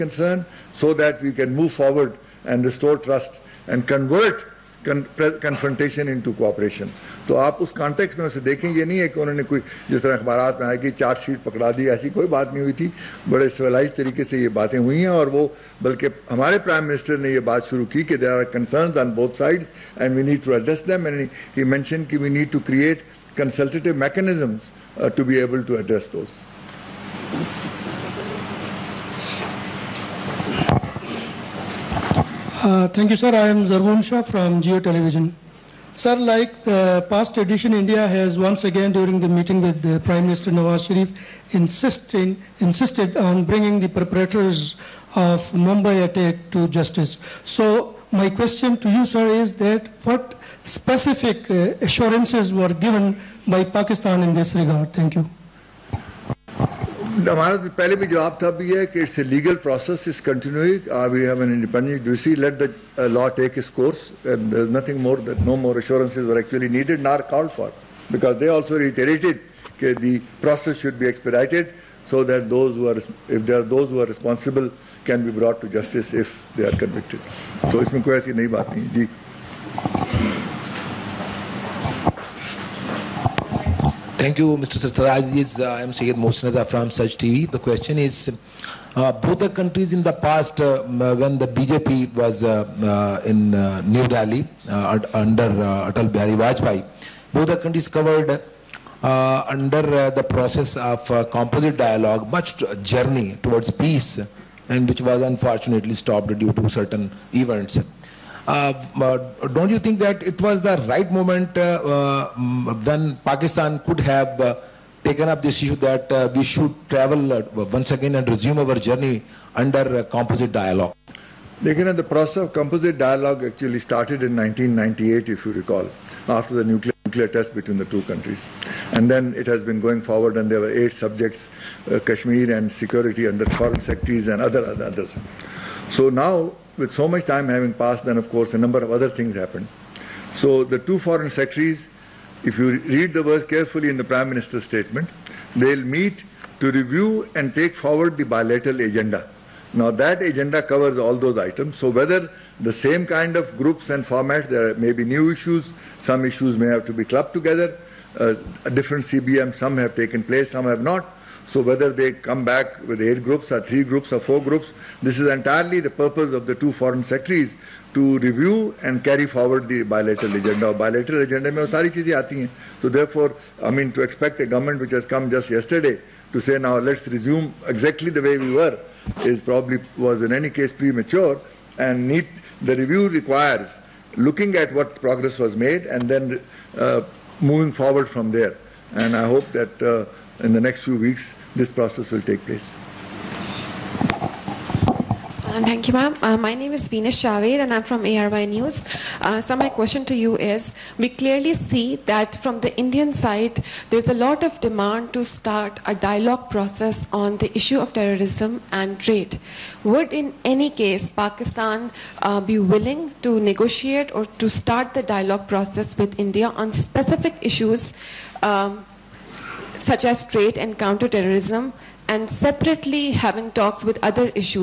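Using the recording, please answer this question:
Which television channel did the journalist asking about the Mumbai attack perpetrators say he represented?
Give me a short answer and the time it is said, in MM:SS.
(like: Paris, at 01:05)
Geo Television, at 00:34.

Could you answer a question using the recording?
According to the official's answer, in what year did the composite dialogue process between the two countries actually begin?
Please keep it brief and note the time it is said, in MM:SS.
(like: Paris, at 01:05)
1998, at 02:04.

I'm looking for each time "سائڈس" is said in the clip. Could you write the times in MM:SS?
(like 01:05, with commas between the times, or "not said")
00:19.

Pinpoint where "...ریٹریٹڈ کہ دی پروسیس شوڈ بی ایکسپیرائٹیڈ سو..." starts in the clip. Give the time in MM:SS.
01:08.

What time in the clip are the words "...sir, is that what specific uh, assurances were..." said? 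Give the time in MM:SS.
00:49.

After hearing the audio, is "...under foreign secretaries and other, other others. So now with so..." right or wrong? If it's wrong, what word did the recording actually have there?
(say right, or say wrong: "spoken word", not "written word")
right.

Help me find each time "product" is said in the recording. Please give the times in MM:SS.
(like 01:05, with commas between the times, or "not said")
not said.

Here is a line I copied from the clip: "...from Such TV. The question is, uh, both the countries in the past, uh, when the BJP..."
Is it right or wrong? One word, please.
right.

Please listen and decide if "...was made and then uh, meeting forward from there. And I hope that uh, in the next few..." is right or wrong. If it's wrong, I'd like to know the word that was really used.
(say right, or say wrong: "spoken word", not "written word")
wrong: "moving", not "meeting".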